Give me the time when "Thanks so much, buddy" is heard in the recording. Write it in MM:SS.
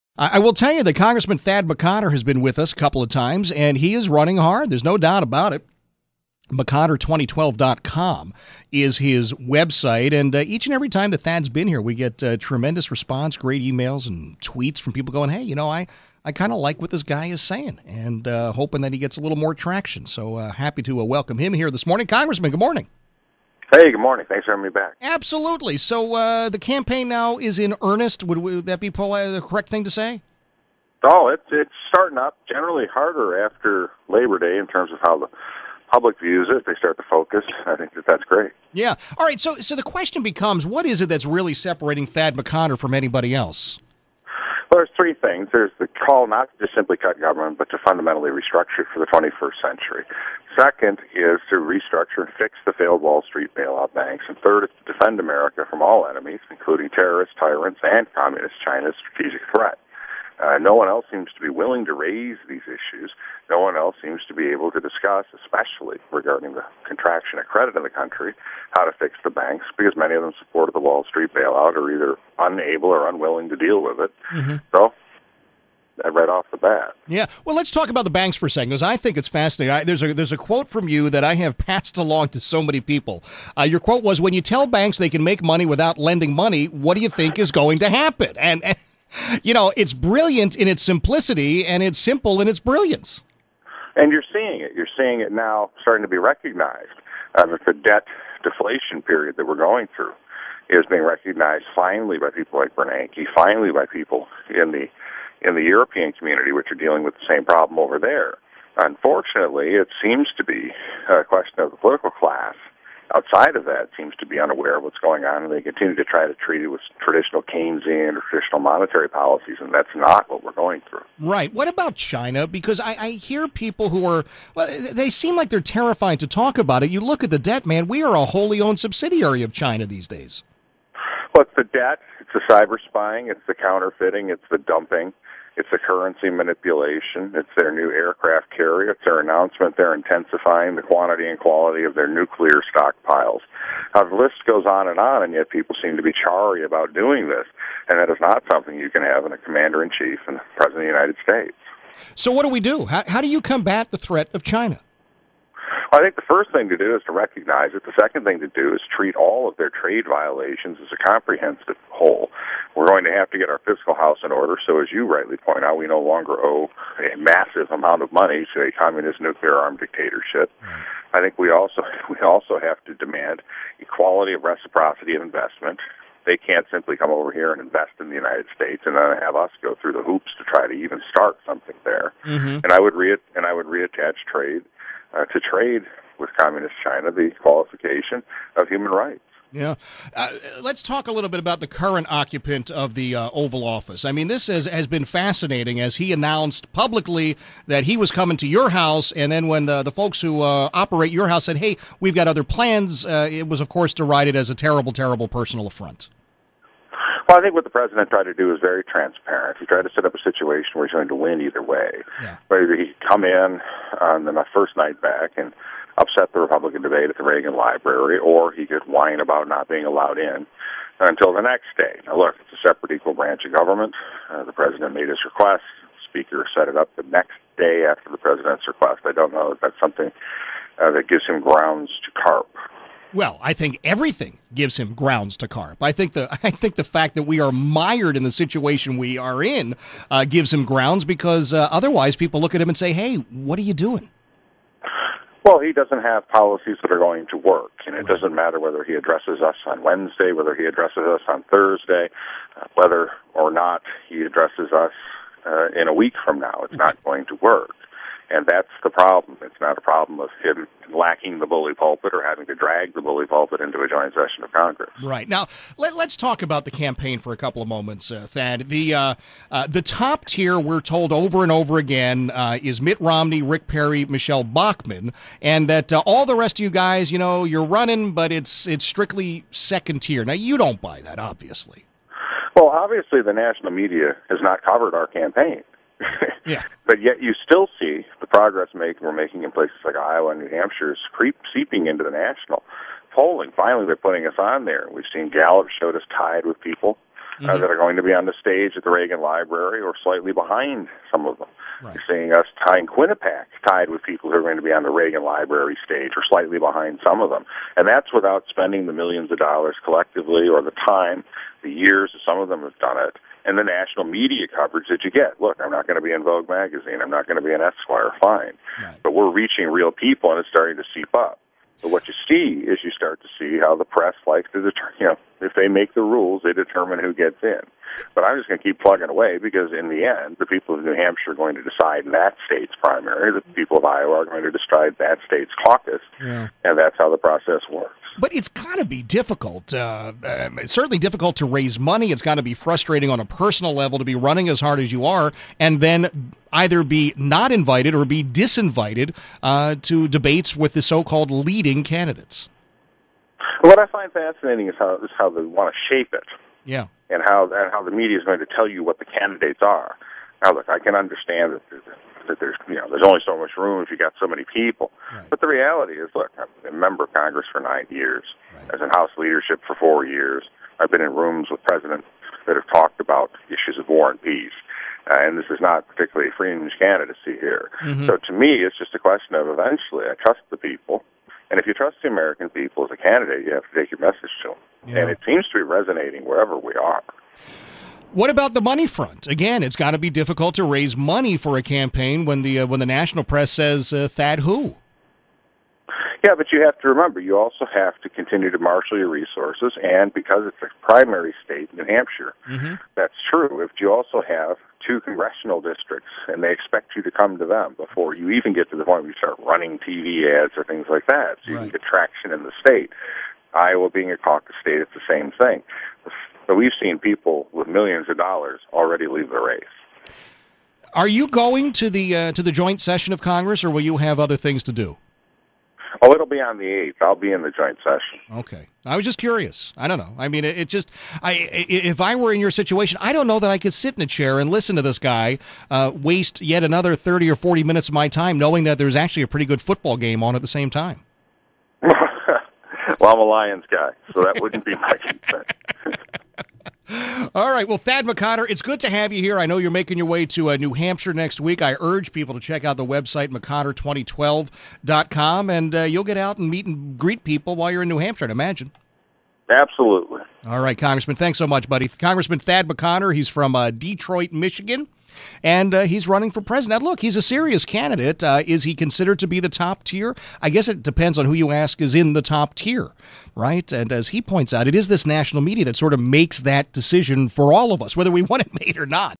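07:41.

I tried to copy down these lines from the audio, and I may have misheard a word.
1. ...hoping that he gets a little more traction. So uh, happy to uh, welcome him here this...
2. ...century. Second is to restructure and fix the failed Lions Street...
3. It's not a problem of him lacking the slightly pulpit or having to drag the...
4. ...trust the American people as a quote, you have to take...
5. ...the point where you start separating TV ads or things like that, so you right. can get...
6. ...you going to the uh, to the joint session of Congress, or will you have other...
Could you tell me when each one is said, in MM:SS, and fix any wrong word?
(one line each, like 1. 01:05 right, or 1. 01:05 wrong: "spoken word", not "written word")
1. 00:18 right
2. 00:49 wrong: "Wall", not "Lions"
3. 04:19 wrong: "bully", not "slightly"
4. 06:21 wrong: "candidate", not "quote"
5. 06:48 wrong: "running", not "separating"
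6. 07:01 right.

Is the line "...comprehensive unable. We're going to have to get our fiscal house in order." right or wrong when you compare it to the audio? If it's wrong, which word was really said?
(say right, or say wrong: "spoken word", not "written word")
wrong: "whole", not "unable".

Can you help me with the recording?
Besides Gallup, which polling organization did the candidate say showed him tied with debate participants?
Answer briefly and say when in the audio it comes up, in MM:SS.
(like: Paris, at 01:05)
Quinnipiac, at 05:02.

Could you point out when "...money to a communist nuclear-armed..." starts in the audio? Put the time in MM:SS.
02:48.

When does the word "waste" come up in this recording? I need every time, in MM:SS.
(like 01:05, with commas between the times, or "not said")
07:15.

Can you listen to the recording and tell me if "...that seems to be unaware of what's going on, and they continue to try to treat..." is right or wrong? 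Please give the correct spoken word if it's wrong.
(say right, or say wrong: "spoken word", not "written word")
right.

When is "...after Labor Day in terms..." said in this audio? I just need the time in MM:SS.
00:33.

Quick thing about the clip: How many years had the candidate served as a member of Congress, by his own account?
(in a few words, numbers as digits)
9.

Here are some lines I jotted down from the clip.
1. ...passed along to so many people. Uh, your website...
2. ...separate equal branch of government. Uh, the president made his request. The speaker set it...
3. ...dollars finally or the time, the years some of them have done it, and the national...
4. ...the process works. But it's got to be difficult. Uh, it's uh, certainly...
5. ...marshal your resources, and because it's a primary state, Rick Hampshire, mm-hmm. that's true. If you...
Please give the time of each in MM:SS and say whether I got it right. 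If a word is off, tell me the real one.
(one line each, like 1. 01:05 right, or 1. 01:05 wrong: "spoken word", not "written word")
1. 01:21 wrong: "quote", not "website"
2. 03:42 right
3. 05:09 wrong: "collectively", not "finally"
4. 05:37 right
5. 06:38 wrong: "New", not "Rick".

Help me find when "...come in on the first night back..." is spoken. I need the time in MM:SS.
03:32.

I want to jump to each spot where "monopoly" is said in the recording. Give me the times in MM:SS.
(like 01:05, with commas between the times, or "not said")
not said.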